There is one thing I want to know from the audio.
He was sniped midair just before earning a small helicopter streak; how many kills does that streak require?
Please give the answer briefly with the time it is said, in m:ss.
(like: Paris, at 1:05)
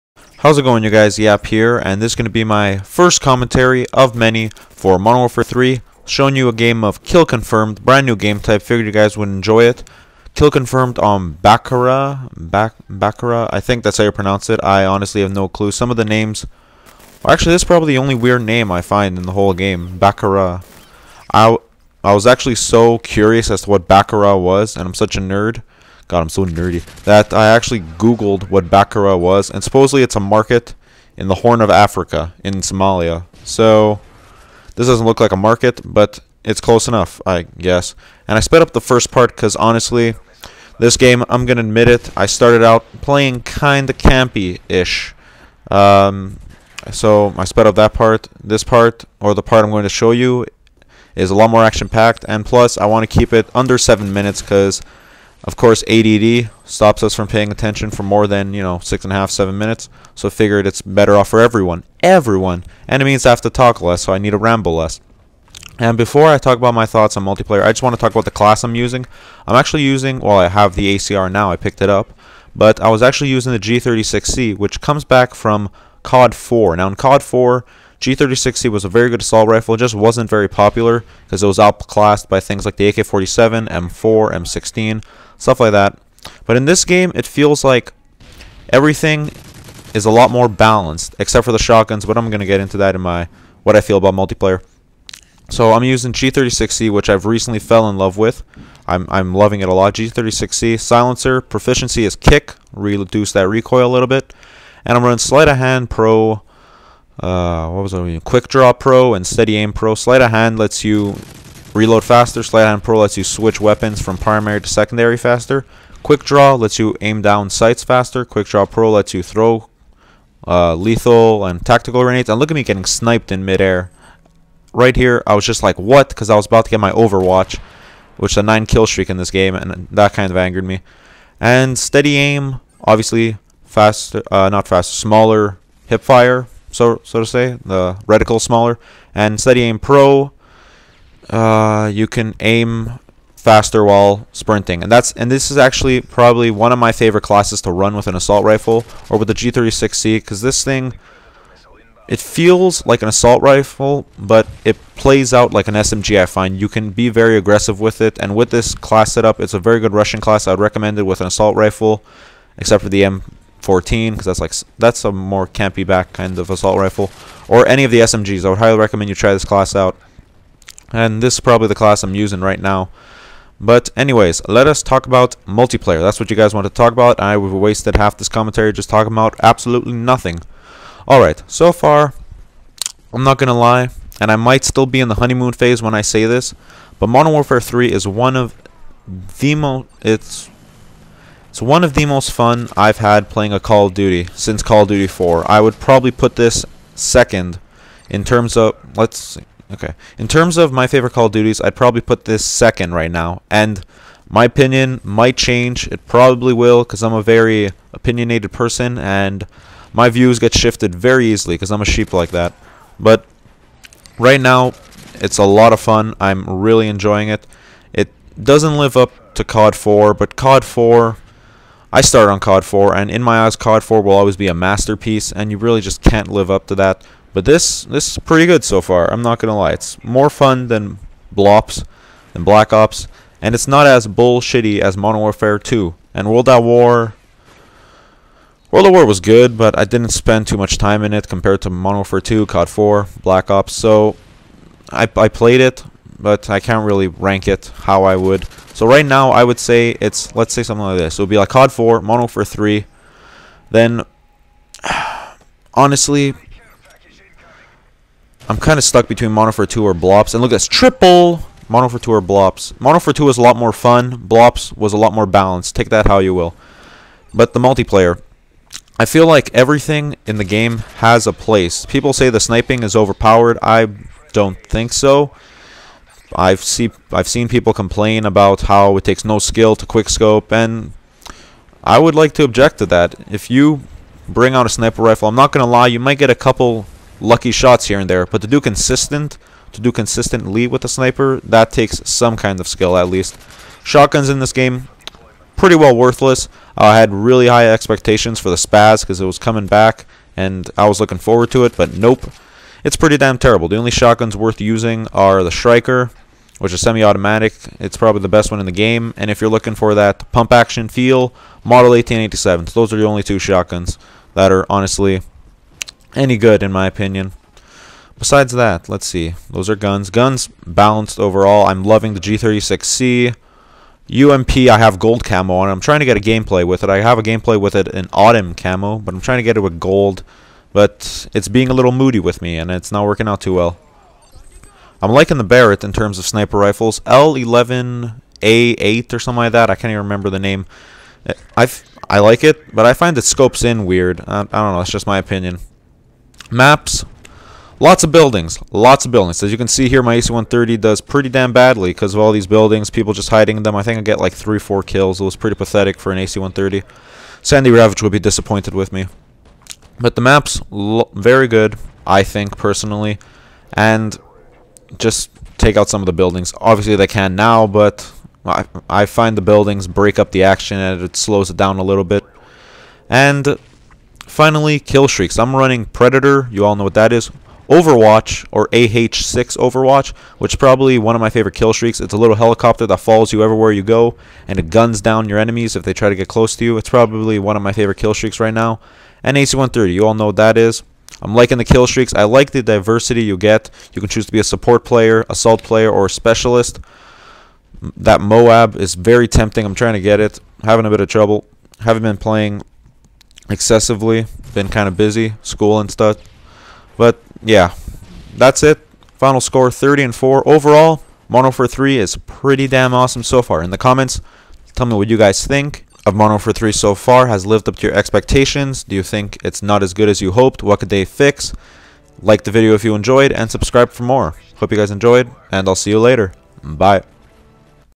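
9, at 2:08.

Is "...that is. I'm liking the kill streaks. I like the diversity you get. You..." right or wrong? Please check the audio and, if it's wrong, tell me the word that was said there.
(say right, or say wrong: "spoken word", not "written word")
right.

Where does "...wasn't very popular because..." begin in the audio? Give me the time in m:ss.
1:19.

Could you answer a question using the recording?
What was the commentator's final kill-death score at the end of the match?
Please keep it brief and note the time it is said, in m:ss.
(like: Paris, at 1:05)
30 and 4, at 6:49.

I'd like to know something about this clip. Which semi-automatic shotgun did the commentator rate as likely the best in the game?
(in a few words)
Striker.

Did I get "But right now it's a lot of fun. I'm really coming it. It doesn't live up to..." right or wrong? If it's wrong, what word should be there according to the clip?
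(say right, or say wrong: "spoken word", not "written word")
wrong: "enjoying", not "coming".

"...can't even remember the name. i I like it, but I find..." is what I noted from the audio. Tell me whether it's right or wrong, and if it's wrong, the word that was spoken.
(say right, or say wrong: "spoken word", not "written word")
right.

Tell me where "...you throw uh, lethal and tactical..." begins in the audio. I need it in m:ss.
1:59.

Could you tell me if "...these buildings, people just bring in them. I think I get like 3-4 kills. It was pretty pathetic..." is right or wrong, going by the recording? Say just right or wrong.
wrong.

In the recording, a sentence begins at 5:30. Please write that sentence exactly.
But it's being a little moody with me, and it's not working out too well.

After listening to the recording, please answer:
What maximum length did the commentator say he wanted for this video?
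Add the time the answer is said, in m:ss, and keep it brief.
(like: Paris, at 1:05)
7 minutes, at 0:53.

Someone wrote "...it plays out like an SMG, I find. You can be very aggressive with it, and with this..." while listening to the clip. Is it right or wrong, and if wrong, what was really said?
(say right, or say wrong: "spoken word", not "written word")
right.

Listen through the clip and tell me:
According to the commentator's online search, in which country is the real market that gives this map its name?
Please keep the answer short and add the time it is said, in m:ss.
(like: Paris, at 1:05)
Somalia, at 0:32.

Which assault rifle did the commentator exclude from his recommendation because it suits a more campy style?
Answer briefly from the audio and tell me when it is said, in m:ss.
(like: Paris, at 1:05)
M14, at 2:43.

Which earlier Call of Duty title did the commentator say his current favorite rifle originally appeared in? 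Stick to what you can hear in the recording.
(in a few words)
COD 4.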